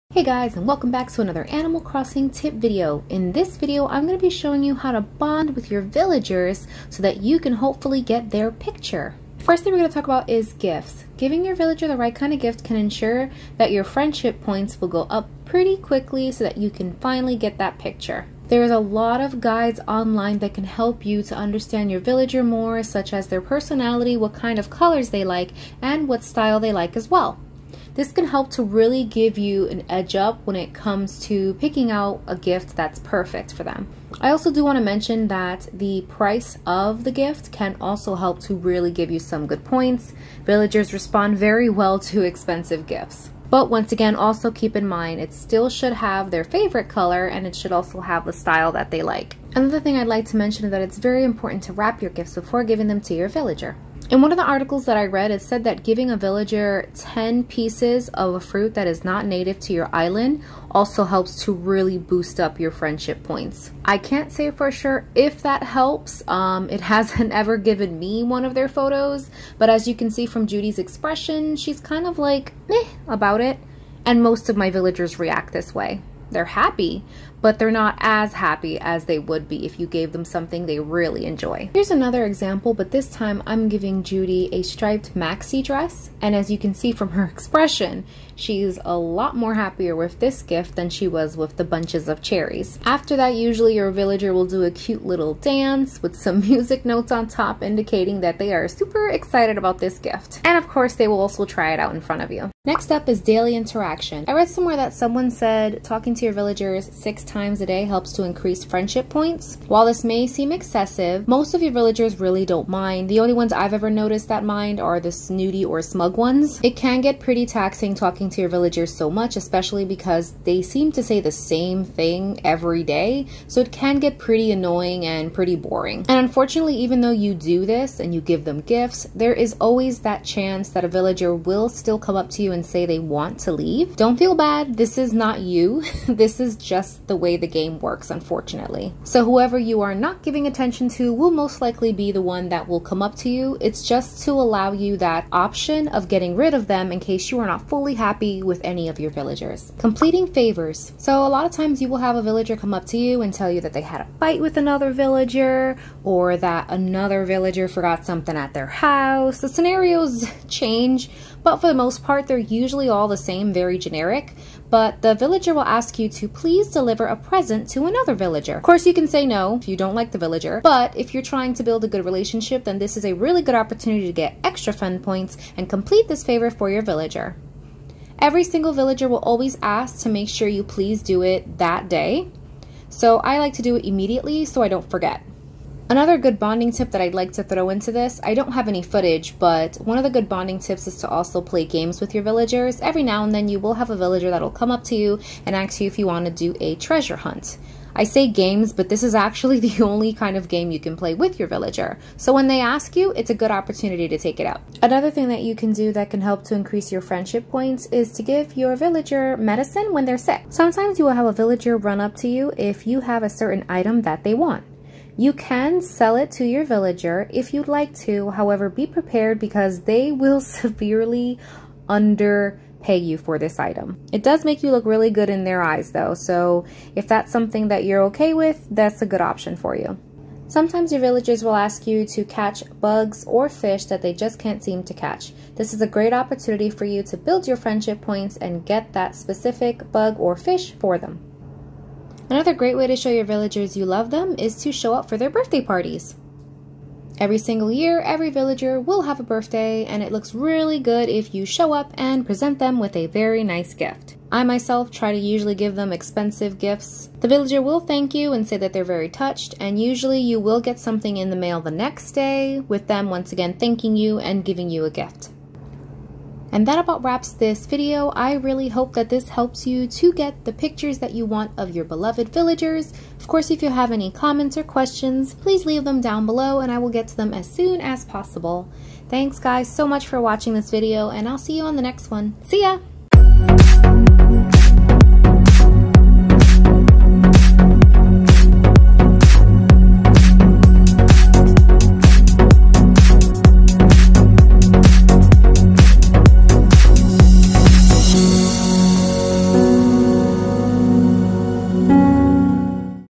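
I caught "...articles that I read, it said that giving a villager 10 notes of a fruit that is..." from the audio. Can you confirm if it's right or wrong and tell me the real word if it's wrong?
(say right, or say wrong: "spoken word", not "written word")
wrong: "pieces", not "notes".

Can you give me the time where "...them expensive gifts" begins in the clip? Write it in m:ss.
4:15.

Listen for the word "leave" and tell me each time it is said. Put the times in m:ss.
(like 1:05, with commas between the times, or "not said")
2:13, 4:35.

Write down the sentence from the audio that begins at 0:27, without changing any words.
This can help to really give you an edge up when it comes to picking out a gift that's perfect for them.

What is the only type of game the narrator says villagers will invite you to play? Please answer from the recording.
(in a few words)
treasure hunt.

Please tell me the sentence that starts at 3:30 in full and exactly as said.
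Sometimes you will have a villager run up to you if you have a certain item that they want.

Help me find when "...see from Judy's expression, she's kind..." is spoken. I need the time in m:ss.
1:10.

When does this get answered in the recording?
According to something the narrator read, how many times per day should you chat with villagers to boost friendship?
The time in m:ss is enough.
1:46.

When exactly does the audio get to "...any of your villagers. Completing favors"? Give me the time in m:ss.
2:28.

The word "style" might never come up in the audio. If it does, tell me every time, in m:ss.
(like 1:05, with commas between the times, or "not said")
0:26, 0:48.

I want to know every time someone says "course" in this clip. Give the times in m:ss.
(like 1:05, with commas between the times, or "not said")
1:40, 2:48, 4:33.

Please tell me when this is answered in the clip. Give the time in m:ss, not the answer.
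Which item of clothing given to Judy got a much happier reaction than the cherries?
1:24.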